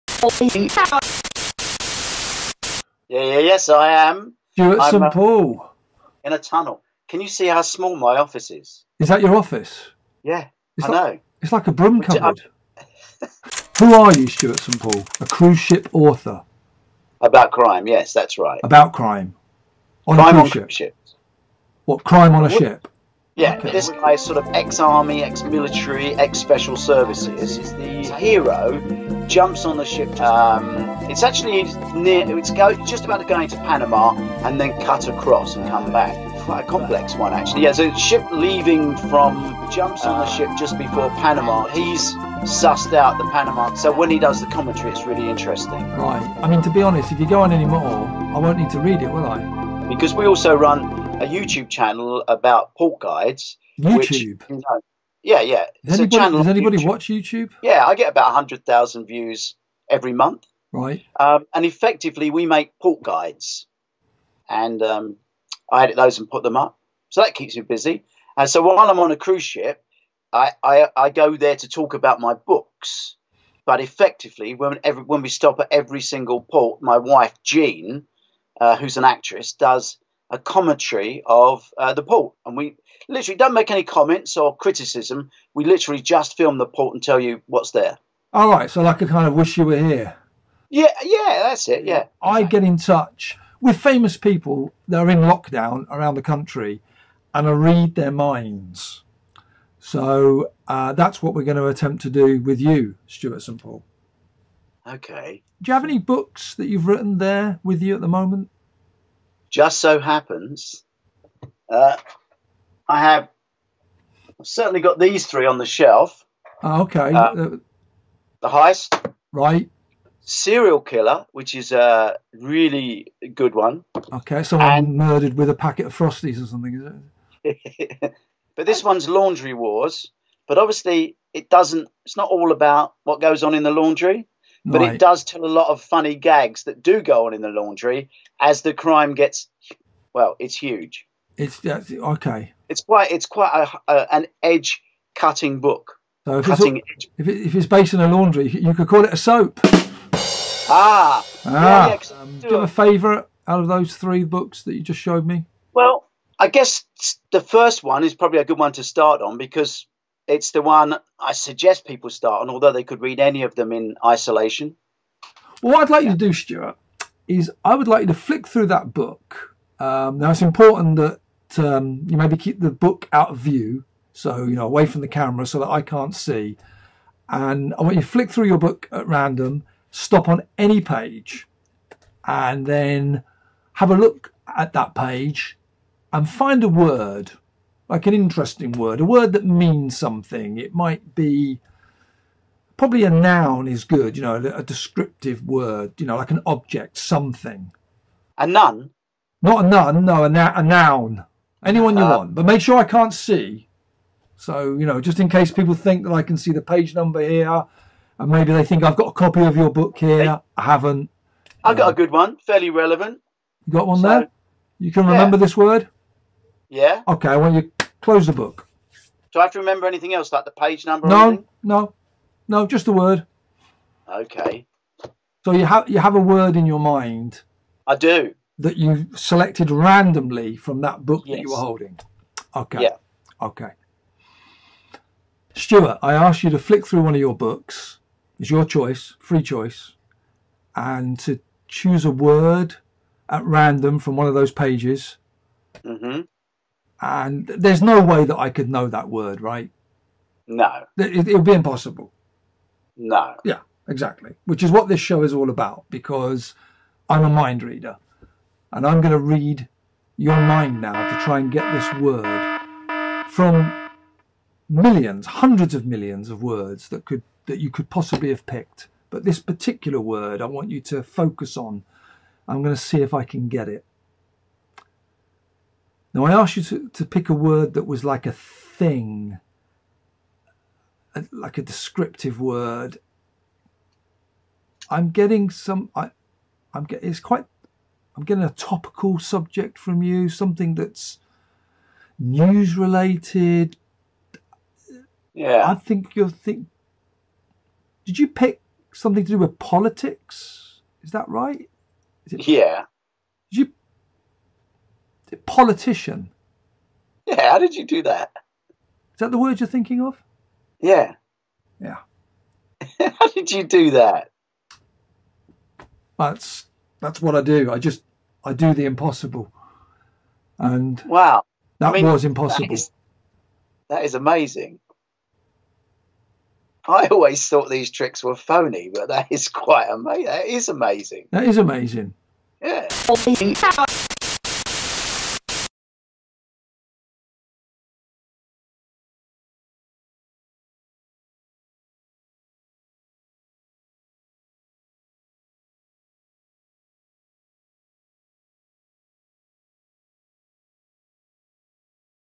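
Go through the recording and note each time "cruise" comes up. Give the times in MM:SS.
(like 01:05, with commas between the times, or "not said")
00:15, 00:20, 01:09.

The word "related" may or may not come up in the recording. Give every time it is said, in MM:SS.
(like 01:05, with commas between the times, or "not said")
04:52.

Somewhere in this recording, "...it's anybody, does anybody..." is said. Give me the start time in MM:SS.
00:55.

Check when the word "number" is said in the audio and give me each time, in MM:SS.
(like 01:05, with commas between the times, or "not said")
03:26, 03:40.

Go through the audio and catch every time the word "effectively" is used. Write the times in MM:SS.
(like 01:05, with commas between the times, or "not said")
01:01, 01:13.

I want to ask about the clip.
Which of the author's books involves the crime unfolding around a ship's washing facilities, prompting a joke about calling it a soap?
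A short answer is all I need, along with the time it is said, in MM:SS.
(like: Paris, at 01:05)
Laundry Wars, at 02:09.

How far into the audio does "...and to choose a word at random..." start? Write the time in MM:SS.
04:00.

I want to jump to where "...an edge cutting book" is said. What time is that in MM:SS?
02:24.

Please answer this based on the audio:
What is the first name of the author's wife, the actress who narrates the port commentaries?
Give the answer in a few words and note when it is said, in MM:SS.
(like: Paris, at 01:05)
Jean, at 01:17.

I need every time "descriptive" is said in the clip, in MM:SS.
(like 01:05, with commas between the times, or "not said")
03:14, 04:41.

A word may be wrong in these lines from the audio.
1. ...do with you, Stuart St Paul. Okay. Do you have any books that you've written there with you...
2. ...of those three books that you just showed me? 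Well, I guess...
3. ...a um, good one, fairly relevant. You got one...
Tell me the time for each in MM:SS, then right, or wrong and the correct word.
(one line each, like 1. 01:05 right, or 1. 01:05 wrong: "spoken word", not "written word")
1. 01:42 right
2. 02:33 right
3. 03:31 right.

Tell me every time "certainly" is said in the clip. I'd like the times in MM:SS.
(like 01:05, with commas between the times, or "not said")
01:54.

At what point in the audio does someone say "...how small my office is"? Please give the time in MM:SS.
00:07.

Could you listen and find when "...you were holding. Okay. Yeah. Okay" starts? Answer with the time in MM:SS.
03:51.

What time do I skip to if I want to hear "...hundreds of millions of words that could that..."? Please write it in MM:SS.
04:25.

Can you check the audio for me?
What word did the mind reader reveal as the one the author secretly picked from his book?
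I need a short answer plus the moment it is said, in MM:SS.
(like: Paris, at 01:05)
politician, at 05:05.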